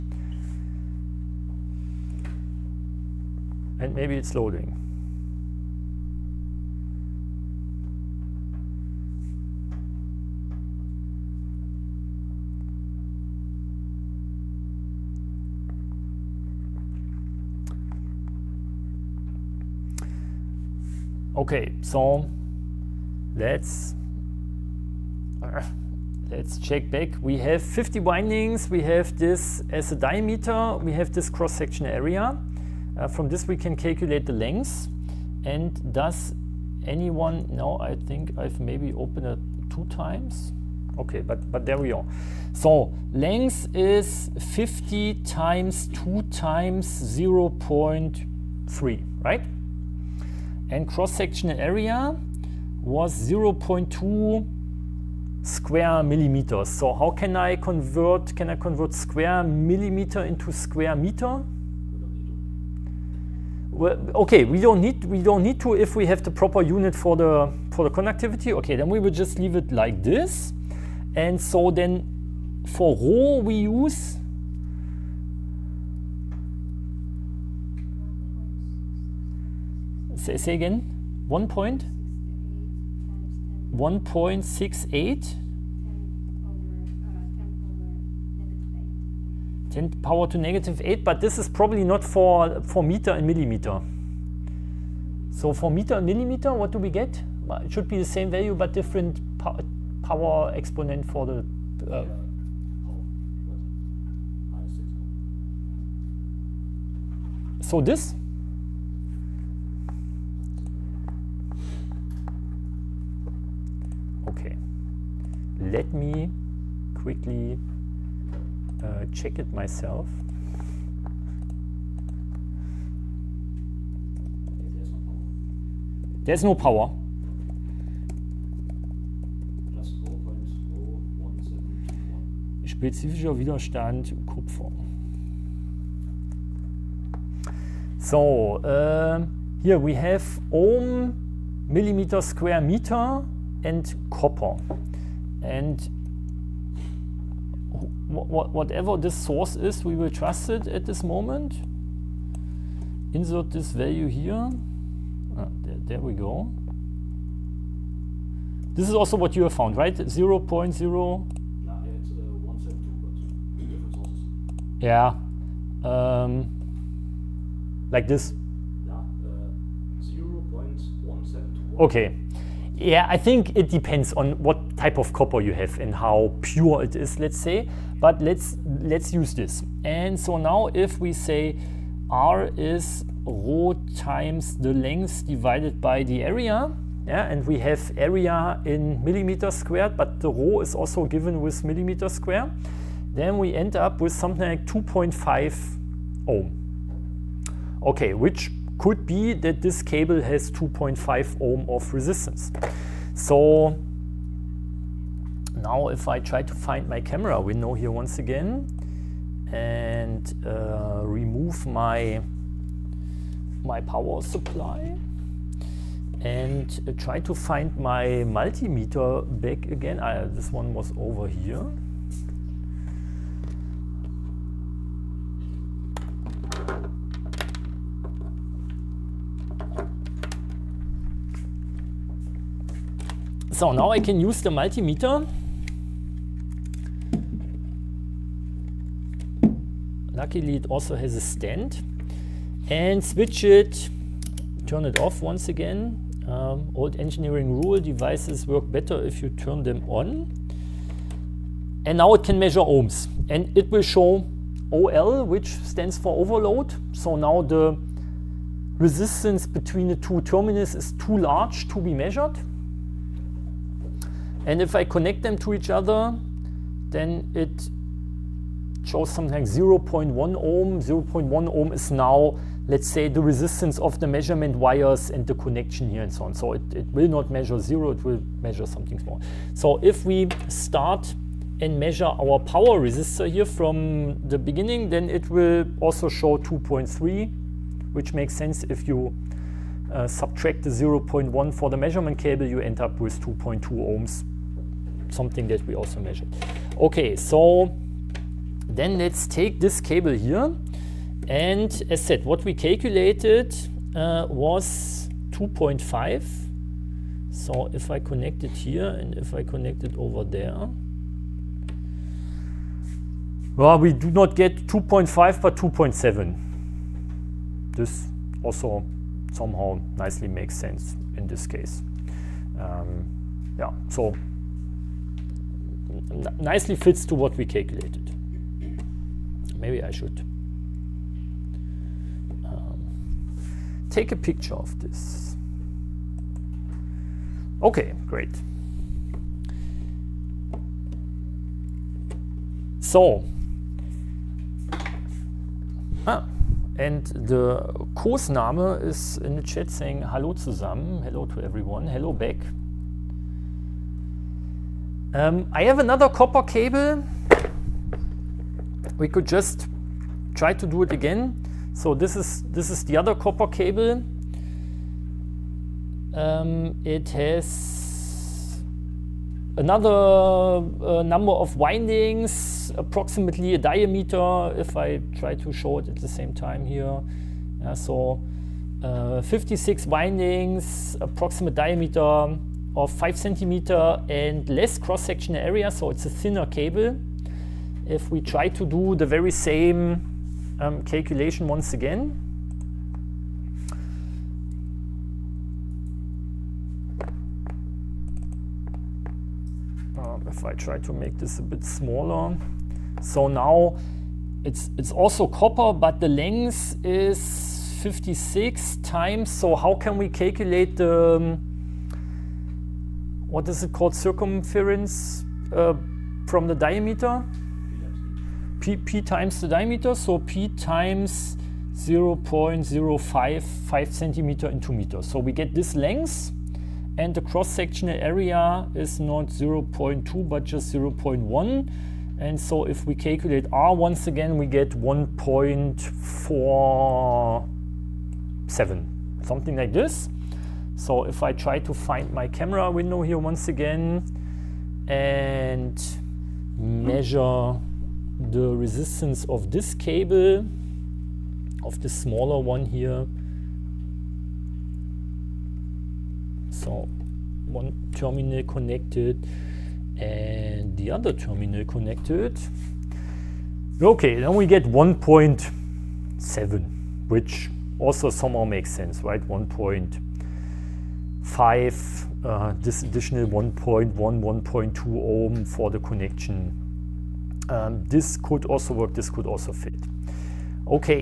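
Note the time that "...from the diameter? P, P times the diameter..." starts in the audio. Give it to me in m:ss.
6:56.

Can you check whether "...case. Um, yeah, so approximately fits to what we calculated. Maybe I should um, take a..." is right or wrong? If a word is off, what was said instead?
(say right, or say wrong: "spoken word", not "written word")
wrong: "nicely", not "approximately".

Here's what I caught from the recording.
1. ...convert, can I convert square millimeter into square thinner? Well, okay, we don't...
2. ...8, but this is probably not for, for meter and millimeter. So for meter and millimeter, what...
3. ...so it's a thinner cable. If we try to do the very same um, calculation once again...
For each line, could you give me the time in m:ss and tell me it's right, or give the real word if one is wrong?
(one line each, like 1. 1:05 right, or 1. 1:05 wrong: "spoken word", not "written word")
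1. 0:57 wrong: "meter", not "thinner"
2. 1:30 right
3. 6:25 right.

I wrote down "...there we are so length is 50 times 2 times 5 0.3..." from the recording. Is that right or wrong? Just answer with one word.
wrong.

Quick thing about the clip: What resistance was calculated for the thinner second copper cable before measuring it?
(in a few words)
1.47.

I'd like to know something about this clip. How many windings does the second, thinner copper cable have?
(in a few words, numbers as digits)
56.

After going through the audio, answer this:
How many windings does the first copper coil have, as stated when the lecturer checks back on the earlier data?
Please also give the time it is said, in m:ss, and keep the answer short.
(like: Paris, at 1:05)
50, at 0:27.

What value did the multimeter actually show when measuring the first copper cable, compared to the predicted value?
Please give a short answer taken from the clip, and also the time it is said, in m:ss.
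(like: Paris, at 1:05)
2.7, at 5:15.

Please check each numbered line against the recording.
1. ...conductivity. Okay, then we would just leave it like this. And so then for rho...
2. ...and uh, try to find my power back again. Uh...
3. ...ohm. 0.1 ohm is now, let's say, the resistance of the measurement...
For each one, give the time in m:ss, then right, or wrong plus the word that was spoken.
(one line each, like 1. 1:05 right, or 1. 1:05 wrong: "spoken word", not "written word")
1. 1:07 right
2. 3:36 wrong: "multimeter", not "power"
3. 4:30 right.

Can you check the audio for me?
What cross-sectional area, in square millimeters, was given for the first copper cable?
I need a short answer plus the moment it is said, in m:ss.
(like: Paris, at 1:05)
0.2 square millimeters, at 0:53.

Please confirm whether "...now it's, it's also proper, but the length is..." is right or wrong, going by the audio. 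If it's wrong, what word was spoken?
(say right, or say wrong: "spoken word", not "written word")
wrong: "copper", not "proper".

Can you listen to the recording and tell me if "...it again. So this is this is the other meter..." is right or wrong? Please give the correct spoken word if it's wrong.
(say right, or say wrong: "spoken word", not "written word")
wrong: "copper", not "meter".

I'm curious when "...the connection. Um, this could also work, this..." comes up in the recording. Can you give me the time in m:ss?
7:55.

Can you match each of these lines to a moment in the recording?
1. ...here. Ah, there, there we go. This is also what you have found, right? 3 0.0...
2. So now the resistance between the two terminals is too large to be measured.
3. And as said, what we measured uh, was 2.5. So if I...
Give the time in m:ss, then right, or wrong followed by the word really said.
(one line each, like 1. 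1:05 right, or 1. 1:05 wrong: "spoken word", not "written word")
1. 2:34 wrong: "0", not "3"
2. 4:16 right
3. 5:01 wrong: "calculated", not "measured".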